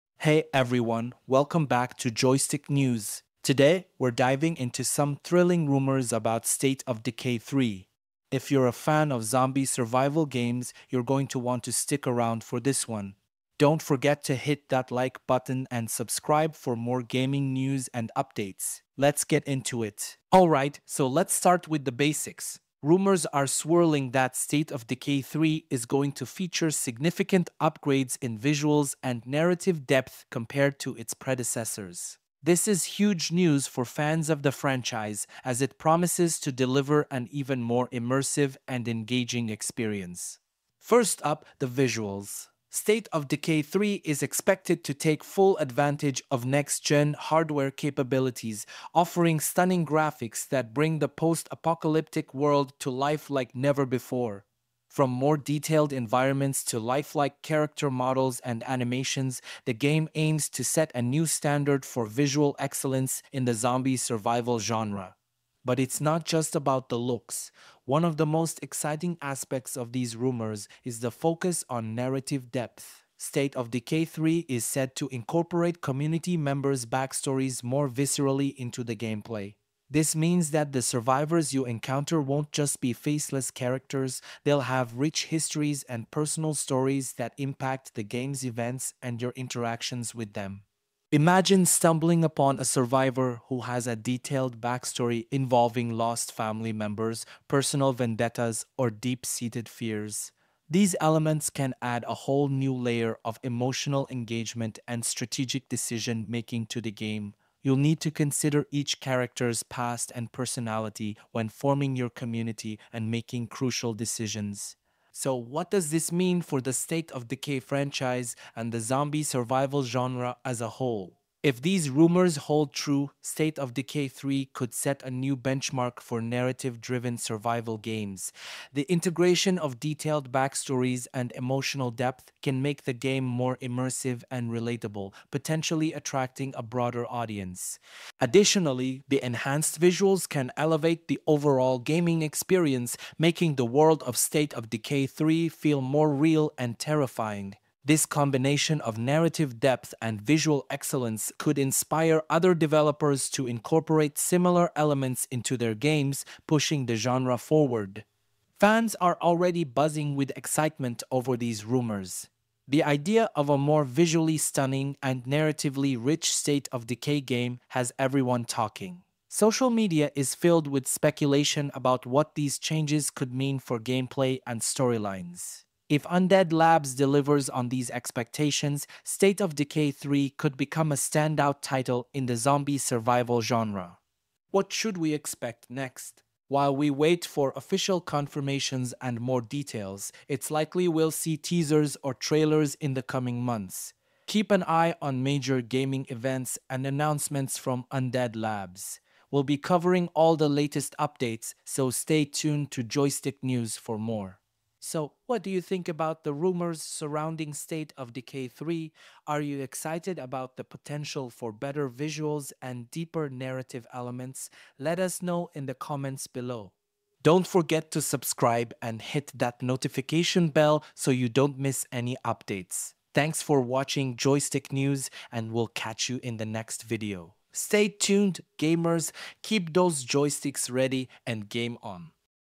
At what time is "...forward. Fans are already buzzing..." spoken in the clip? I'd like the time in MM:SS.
02:37.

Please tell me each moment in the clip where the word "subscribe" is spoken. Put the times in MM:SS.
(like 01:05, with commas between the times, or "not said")
00:15, 03:38.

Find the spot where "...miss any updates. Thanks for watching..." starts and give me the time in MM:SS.
03:41.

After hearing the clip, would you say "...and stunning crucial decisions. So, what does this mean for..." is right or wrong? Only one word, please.
wrong.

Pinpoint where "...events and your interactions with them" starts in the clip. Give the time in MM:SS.
01:28.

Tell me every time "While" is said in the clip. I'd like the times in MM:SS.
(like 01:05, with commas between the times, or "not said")
03:06.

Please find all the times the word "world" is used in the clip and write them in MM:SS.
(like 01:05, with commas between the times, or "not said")
00:52, 02:23.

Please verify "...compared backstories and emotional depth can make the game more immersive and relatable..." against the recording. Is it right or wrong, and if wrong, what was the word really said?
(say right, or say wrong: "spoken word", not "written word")
wrong: "detailed", not "compared".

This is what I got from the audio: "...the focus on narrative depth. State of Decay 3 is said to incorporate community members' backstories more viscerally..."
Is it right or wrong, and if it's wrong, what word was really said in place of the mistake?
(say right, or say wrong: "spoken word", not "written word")
right.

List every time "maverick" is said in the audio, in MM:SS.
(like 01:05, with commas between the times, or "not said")
not said.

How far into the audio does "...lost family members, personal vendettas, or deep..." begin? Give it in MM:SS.
01:35.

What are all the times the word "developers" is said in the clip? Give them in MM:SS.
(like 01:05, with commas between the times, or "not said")
02:32.